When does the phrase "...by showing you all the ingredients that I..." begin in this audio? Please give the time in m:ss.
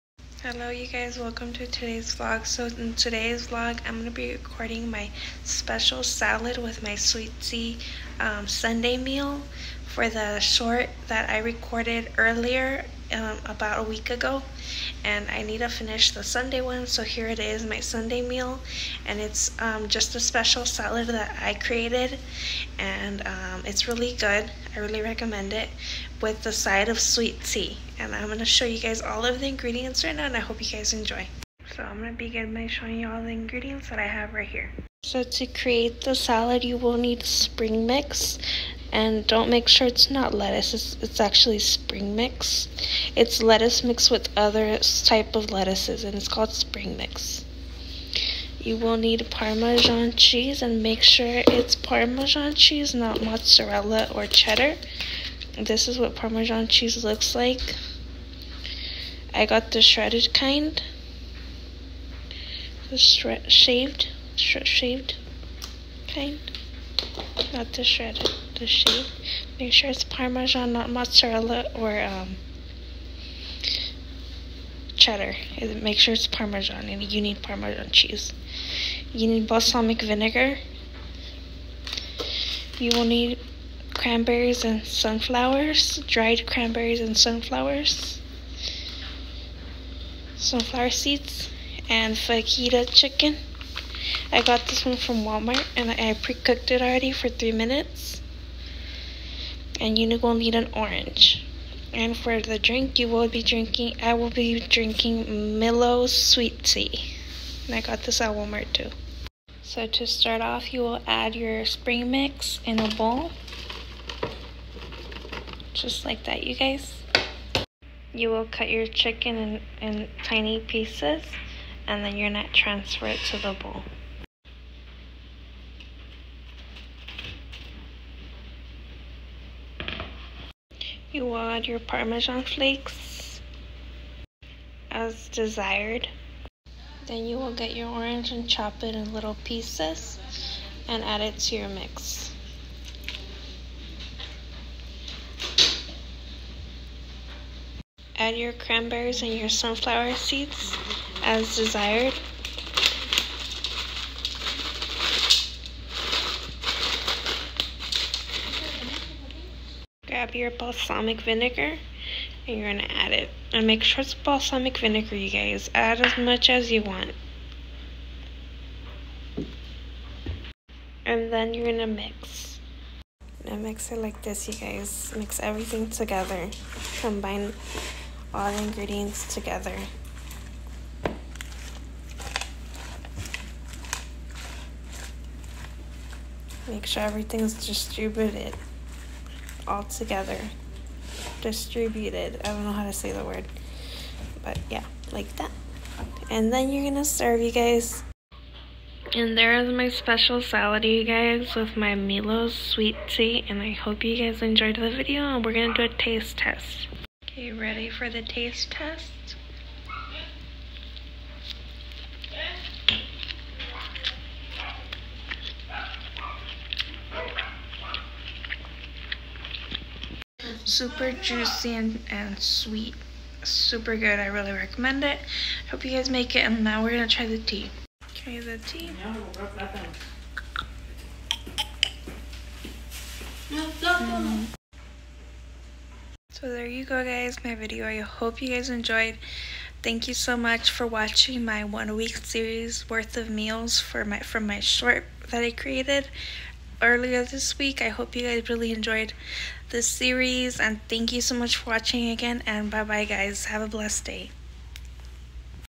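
0:32.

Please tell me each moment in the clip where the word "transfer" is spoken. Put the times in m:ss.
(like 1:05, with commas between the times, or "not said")
2:02.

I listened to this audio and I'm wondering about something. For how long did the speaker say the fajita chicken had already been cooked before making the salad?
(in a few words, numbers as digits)
3 minutes.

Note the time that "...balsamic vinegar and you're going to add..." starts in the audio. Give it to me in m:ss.
2:40.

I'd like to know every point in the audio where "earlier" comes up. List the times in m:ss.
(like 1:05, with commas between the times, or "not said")
0:12, 4:06.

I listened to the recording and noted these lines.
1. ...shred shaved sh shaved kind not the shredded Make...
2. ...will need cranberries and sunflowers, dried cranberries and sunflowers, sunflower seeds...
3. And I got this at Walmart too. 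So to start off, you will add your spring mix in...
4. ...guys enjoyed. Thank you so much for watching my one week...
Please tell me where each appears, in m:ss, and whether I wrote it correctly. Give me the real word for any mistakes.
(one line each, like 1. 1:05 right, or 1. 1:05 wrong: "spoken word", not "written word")
1. 1:02 right
2. 1:22 right
3. 1:47 right
4. 3:58 right.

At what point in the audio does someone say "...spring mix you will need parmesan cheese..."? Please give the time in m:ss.
0:46.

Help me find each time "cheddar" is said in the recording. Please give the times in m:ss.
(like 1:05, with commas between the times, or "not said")
0:54, 1:14.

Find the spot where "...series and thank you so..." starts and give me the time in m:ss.
4:09.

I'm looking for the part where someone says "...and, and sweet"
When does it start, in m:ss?
3:41.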